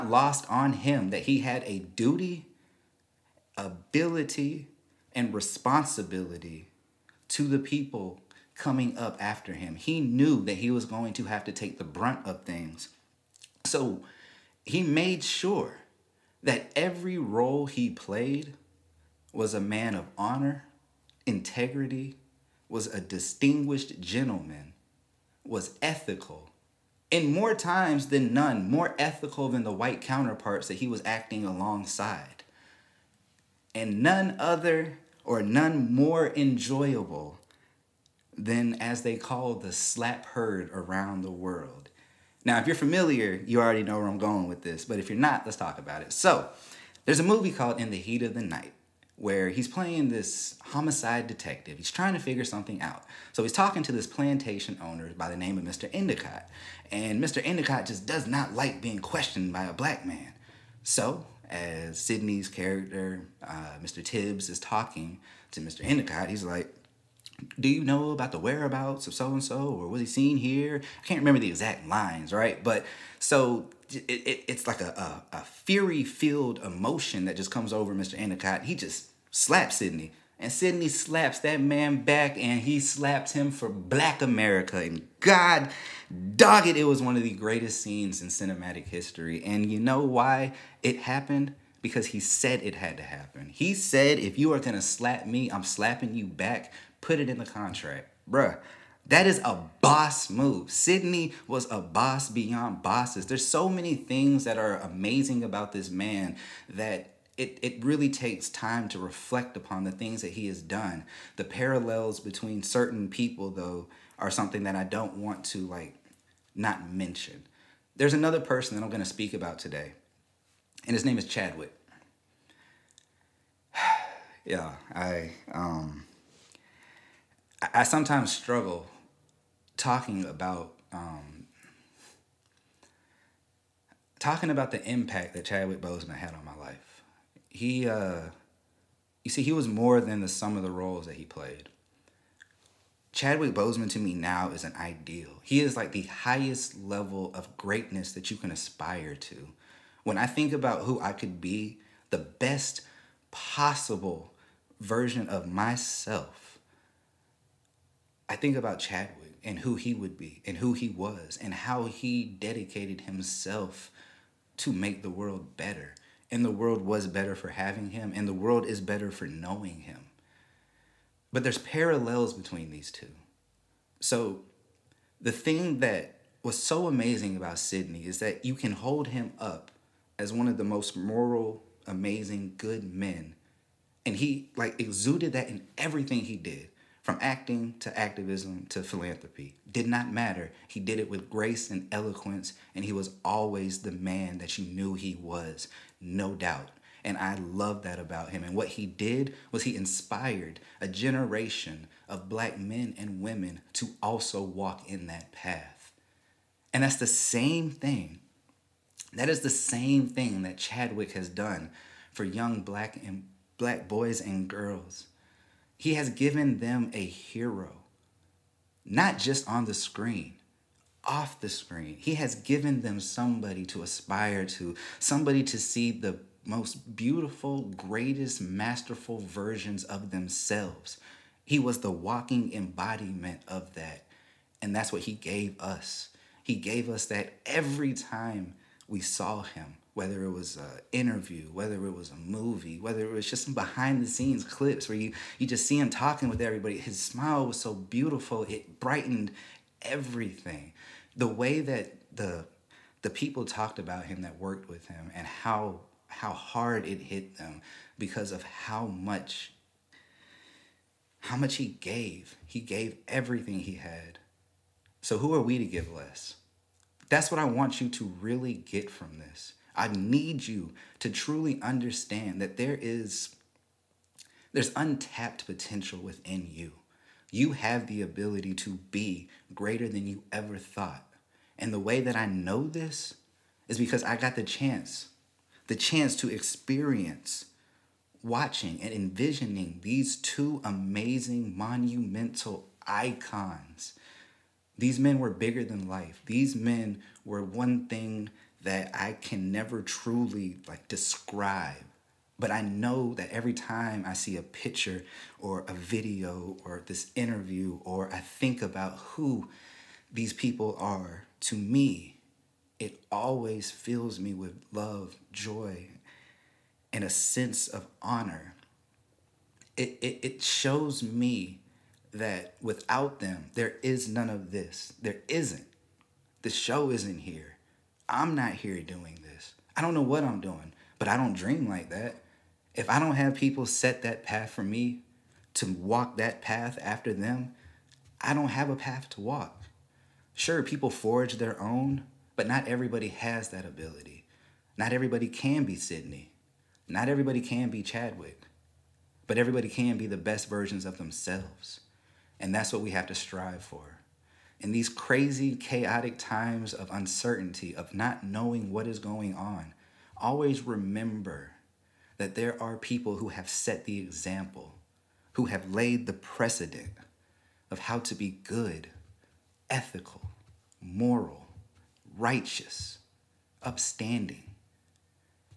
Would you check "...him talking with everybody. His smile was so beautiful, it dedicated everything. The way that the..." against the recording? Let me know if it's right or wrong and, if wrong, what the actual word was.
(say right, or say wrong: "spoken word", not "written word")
wrong: "brightened", not "dedicated".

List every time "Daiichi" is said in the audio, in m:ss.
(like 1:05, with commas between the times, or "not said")
not said.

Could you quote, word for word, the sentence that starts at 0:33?
And none other or none more enjoyable than as they call the slap heard around the world.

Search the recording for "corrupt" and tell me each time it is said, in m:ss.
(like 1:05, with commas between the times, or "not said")
not said.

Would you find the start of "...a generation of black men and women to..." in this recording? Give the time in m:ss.
3:20.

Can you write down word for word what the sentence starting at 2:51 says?
But there's parallels between these two.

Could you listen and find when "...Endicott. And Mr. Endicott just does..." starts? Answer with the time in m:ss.
0:55.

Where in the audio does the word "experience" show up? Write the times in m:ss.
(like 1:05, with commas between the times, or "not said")
4:46.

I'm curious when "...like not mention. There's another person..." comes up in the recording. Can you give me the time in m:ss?
1:55.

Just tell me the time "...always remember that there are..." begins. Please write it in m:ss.
6:00.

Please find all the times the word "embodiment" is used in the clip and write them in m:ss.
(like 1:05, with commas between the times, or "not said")
3:52.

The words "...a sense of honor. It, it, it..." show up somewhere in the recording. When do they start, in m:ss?
5:17.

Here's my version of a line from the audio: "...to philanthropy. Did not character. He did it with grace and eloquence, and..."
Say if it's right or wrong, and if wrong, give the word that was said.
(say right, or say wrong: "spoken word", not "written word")
wrong: "matter", not "character".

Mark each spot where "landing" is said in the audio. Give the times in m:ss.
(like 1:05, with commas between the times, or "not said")
not said.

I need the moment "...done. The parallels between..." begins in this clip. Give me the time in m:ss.
1:50.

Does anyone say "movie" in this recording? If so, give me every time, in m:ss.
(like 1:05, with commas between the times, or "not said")
0:47, 4:02.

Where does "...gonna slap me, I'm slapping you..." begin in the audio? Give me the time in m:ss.
1:34.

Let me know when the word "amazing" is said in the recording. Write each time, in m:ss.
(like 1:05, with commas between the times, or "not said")
1:44, 2:56, 3:01, 4:50.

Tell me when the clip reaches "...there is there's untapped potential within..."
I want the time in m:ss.
4:32.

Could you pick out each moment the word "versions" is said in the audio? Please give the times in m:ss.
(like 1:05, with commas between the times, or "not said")
2:34, 3:49, 5:50.